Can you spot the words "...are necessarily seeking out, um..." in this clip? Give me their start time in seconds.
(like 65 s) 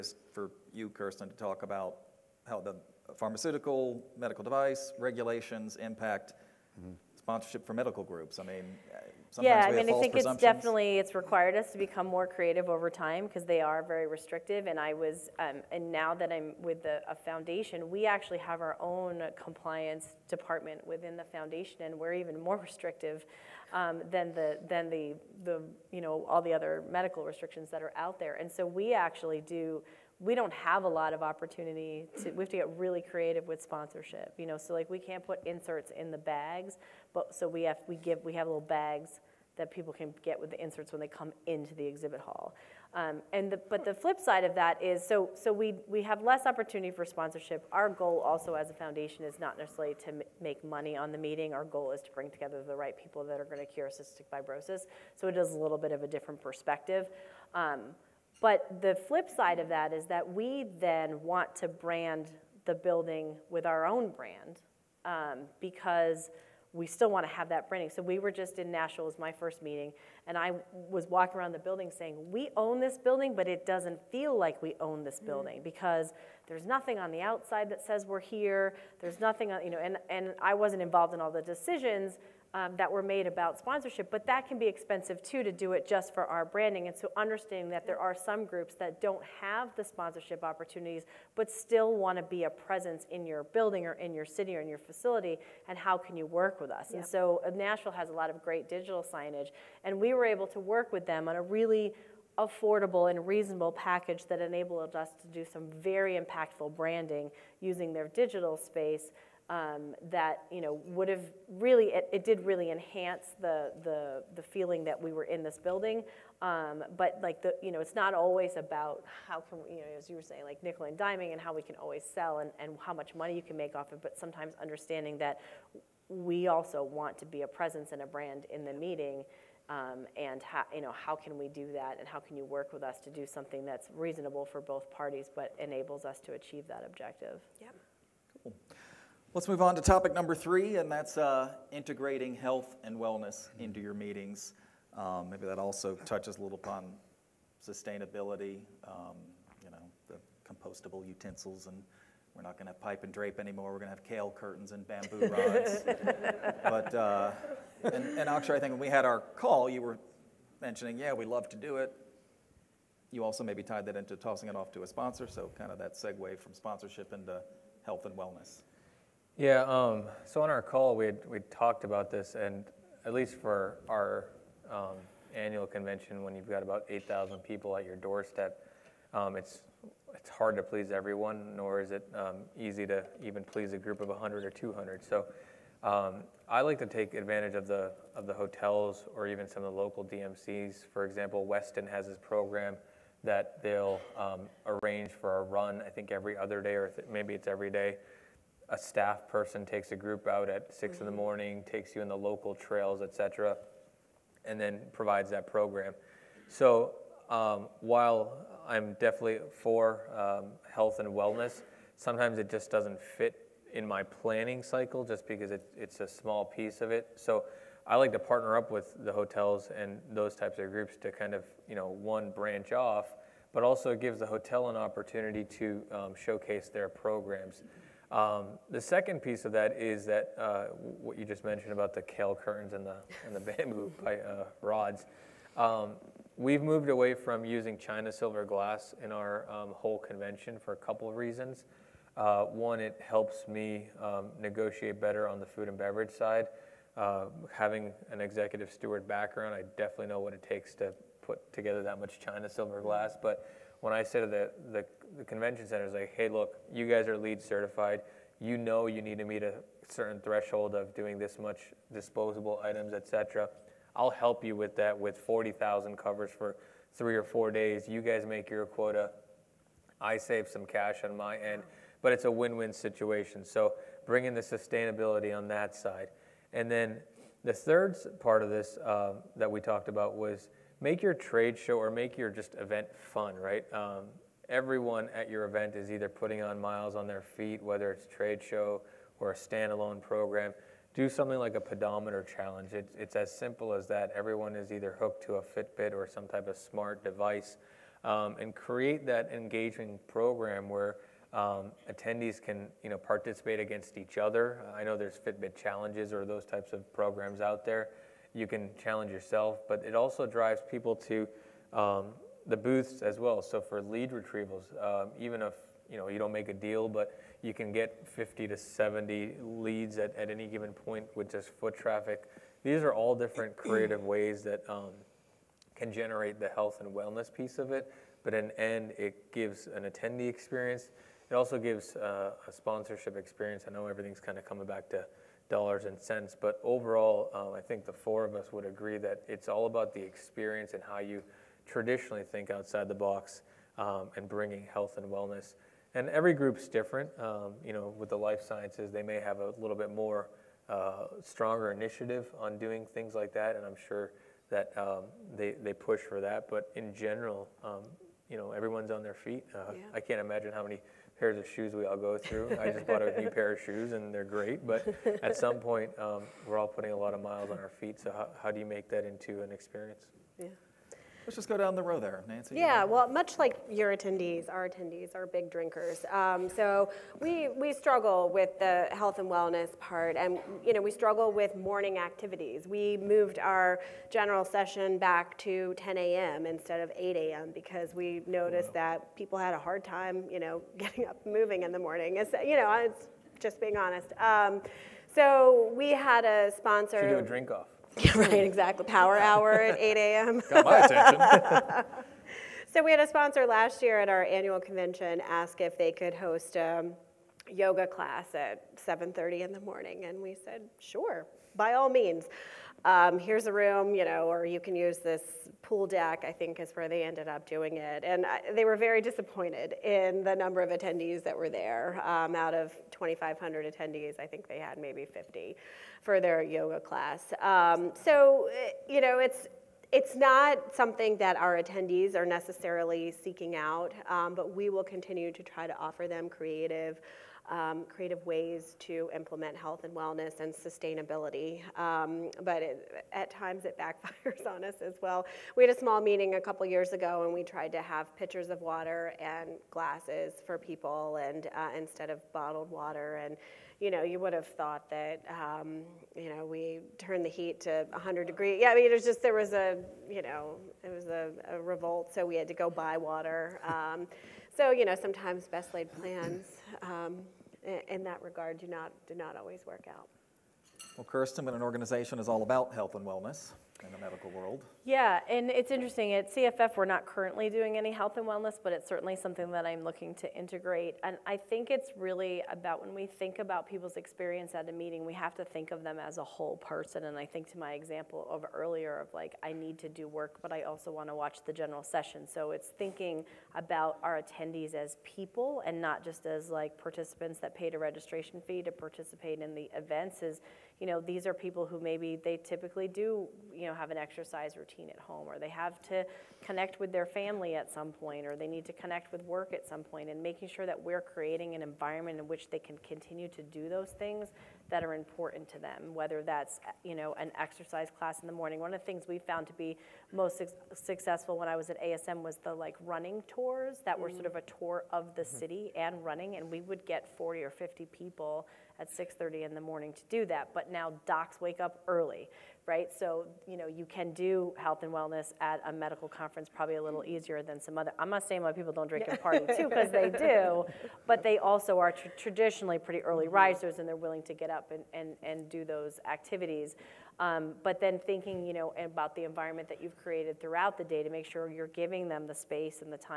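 432 s.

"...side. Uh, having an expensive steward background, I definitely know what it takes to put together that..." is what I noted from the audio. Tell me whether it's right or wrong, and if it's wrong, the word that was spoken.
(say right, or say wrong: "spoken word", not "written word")
wrong: "executive", not "expensive".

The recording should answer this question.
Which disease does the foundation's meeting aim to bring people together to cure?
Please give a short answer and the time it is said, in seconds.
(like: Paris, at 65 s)
cystic fibrosis, at 53 s.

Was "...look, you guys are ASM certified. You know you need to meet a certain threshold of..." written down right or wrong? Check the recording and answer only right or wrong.
wrong.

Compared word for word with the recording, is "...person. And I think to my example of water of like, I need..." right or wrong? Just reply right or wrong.
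wrong.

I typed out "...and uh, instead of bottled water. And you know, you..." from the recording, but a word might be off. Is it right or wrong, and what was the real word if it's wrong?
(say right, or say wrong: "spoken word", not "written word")
right.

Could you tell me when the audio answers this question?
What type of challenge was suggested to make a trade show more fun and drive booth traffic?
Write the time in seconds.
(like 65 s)
291 s.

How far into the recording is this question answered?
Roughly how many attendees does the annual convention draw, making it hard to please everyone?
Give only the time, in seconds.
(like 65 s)
176 s.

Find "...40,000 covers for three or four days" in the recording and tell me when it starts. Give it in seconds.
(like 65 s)
265 s.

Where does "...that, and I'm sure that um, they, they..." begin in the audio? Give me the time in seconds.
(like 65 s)
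353 s.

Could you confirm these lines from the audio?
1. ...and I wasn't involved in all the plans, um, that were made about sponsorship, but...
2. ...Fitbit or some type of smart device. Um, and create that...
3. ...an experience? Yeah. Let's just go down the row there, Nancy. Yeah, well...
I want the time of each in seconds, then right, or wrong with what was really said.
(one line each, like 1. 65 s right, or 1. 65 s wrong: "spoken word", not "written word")
1. 80 s wrong: "decisions", not "plans"
2. 295 s right
3. 369 s right.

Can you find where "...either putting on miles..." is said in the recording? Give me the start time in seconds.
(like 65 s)
285 s.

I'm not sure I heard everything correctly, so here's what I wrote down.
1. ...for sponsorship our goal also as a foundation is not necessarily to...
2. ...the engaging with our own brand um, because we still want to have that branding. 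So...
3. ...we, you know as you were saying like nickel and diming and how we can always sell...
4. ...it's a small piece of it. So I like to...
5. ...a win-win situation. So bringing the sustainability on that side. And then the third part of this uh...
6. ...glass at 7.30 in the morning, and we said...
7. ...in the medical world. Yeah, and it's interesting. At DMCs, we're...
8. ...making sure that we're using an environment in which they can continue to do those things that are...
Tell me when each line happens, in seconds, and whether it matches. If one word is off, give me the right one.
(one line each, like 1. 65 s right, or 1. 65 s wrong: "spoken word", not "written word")
1. 46 s right
2. 62 s wrong: "building", not "engaging"
3. 119 s right
4. 215 s right
5. 272 s right
6. 407 s wrong: "class", not "glass"
7. 473 s wrong: "CFF", not "DMCs"
8. 510 s wrong: "creating", not "using".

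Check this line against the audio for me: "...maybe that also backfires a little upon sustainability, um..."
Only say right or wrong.
wrong.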